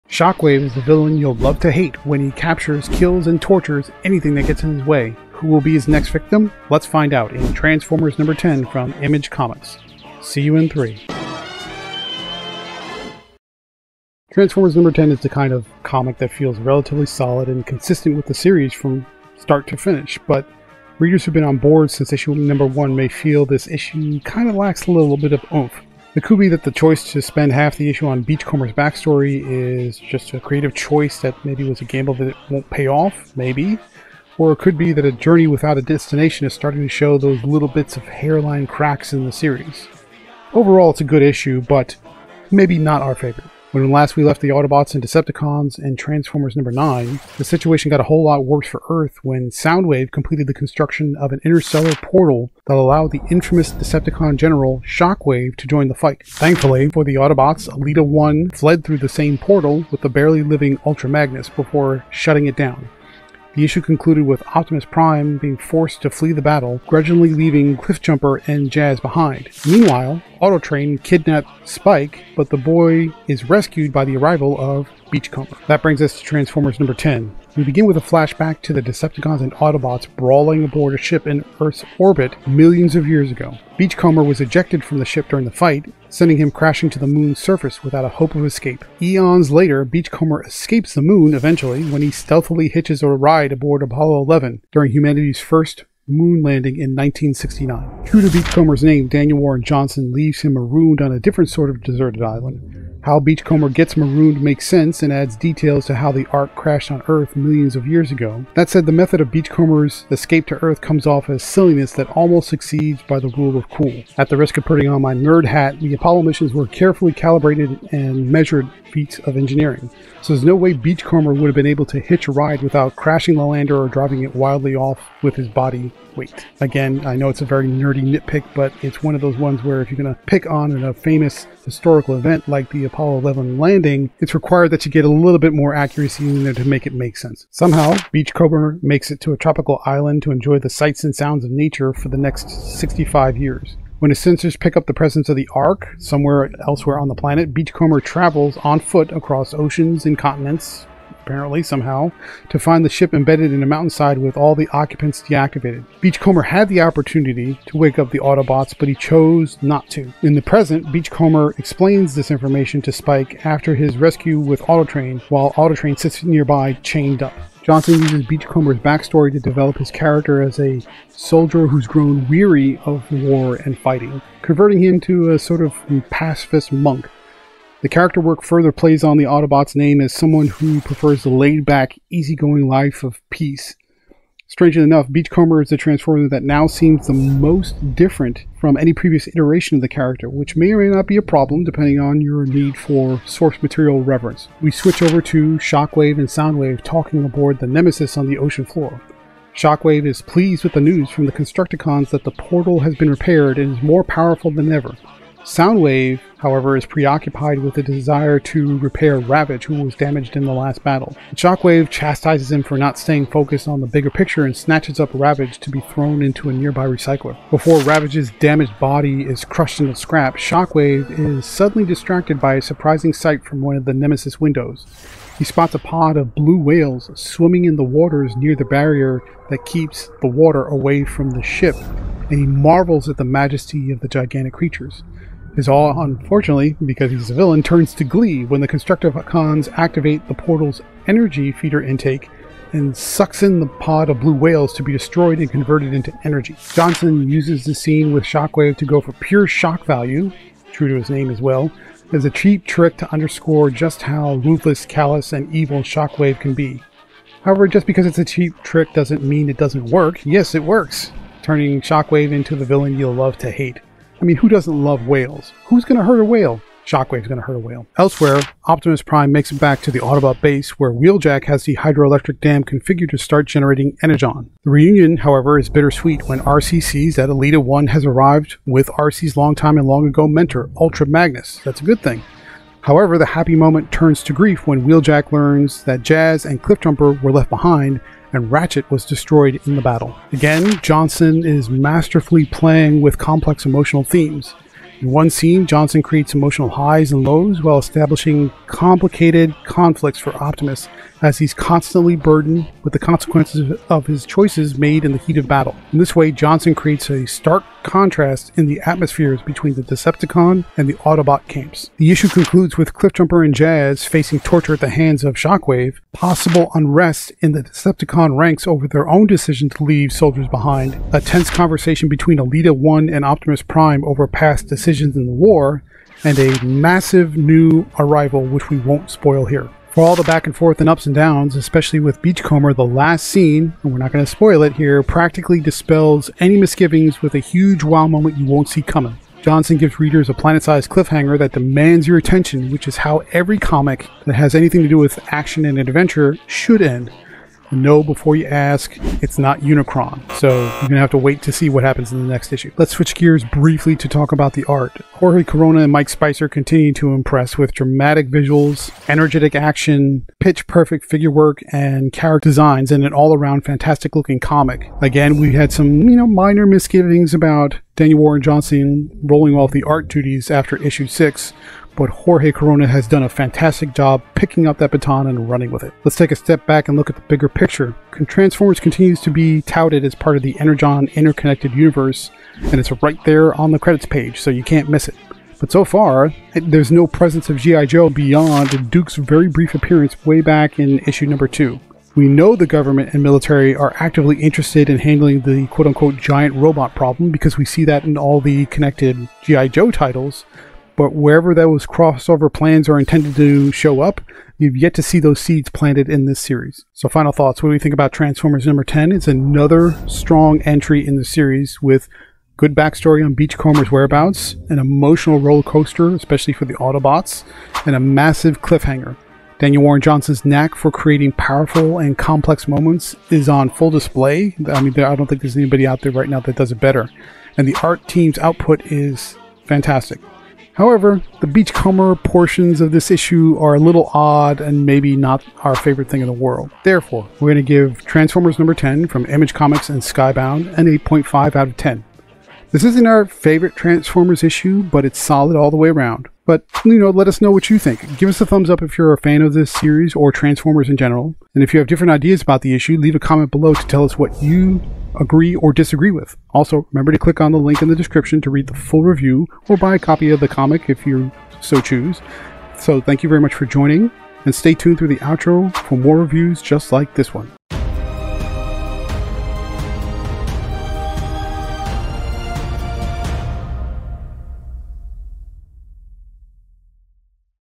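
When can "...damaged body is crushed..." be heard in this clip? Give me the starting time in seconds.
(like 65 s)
218 s.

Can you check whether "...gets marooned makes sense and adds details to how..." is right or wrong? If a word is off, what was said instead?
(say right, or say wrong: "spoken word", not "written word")
right.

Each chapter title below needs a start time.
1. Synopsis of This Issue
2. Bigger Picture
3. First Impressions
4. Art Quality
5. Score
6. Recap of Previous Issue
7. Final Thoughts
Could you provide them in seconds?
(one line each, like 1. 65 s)
1. 75 s
2. 375 s
3. 14 s
4. 352 s
5. 440 s
6. 43 s
7. 406 s.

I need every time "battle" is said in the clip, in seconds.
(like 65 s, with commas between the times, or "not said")
66 s, 210 s, 289 s, 305 s.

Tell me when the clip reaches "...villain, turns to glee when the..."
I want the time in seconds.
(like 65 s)
237 s.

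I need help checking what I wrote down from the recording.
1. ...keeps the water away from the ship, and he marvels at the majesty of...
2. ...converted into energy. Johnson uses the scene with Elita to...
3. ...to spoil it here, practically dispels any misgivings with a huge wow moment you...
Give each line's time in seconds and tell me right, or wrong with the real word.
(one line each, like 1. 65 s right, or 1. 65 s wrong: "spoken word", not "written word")
1. 229 s right
2. 245 s wrong: "Shockwave", not "Elita"
3. 334 s right.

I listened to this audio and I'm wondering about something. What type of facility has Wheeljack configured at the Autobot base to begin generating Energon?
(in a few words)
hydroelectric dam.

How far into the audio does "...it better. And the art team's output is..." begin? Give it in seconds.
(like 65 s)
426 s.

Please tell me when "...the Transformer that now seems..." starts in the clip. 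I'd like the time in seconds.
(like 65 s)
185 s.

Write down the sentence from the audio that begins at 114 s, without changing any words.
At the risk of putting on my nerd hat, the Apollo missions were carefully calibrated and measured feats of engineering.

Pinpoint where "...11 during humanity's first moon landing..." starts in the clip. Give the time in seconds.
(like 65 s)
94 s.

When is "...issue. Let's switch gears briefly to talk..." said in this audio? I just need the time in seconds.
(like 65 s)
352 s.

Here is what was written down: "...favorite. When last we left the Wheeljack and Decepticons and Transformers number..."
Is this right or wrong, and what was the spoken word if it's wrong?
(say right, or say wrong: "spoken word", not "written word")
wrong: "Autobots", not "Wheeljack".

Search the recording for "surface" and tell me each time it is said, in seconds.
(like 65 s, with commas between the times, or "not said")
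87 s.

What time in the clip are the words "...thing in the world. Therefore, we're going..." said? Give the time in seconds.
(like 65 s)
436 s.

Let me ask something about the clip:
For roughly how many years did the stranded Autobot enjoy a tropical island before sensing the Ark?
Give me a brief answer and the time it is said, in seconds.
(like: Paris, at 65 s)
65, at 142 s.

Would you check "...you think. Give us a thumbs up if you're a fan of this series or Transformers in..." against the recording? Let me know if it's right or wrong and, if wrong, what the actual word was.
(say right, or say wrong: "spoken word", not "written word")
right.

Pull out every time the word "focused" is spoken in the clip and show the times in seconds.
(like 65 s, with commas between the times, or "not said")
213 s.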